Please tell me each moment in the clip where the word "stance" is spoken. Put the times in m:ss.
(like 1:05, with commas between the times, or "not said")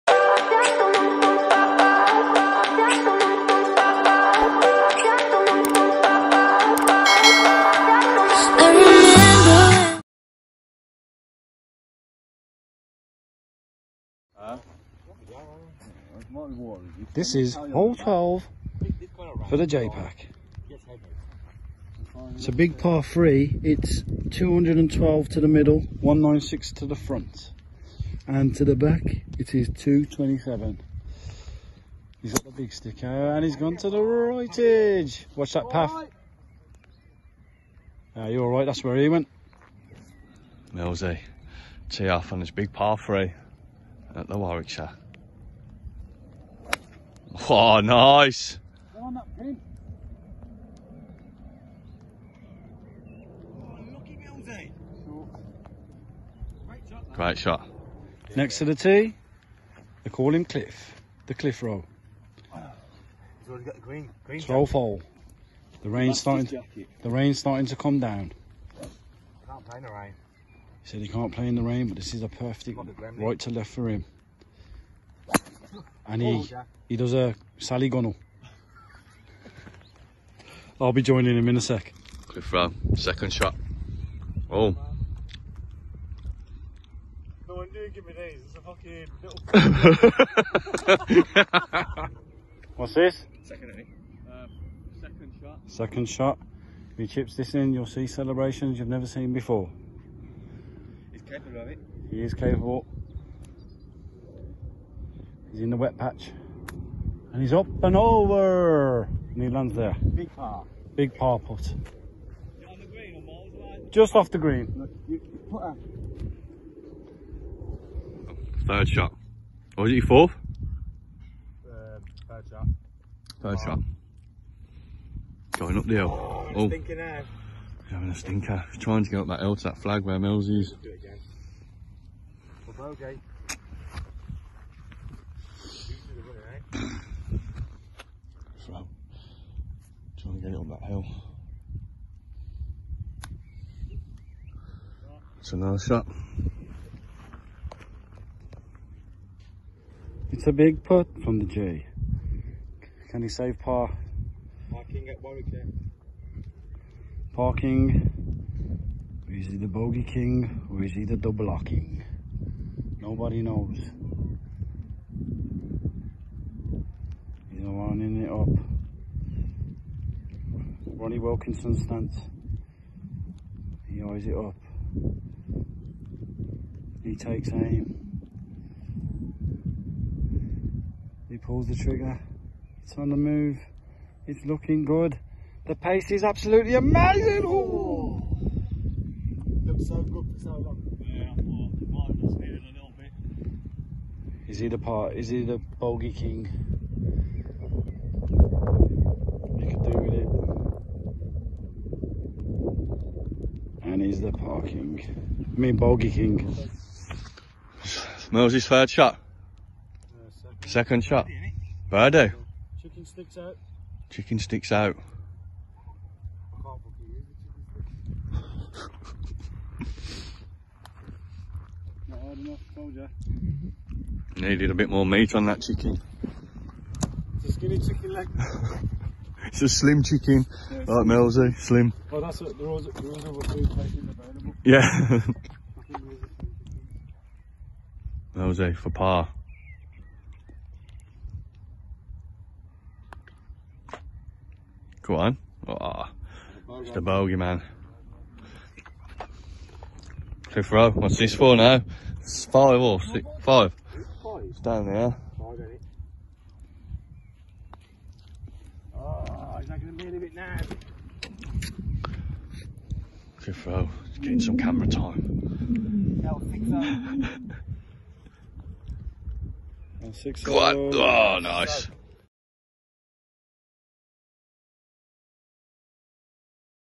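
2:51.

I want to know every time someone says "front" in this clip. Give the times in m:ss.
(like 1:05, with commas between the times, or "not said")
0:26.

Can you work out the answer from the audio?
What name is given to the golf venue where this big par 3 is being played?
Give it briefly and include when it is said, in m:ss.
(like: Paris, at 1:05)
the Warwickshire, at 0:44.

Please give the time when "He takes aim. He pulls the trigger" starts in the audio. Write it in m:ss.
2:57.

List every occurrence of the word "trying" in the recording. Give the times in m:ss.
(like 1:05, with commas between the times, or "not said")
2:08, 2:20.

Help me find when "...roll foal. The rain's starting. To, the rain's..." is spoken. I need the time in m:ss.
1:04.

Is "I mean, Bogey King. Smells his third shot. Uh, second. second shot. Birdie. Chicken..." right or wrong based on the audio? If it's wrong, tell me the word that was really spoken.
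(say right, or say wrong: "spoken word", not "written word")
right.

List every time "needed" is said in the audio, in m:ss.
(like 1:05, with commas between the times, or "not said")
3:12, 3:44.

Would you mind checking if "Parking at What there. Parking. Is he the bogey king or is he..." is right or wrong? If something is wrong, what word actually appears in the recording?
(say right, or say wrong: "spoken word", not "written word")
wrong: "Warwick", not "What".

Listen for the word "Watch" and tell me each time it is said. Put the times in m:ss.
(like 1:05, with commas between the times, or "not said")
0:35.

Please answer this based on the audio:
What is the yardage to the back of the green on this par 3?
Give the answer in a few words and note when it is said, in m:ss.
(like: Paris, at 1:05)
227, at 0:29.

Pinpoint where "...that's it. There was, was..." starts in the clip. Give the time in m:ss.
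3:52.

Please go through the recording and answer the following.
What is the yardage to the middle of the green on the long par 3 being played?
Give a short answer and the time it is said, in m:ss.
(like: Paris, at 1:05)
212, at 0:24.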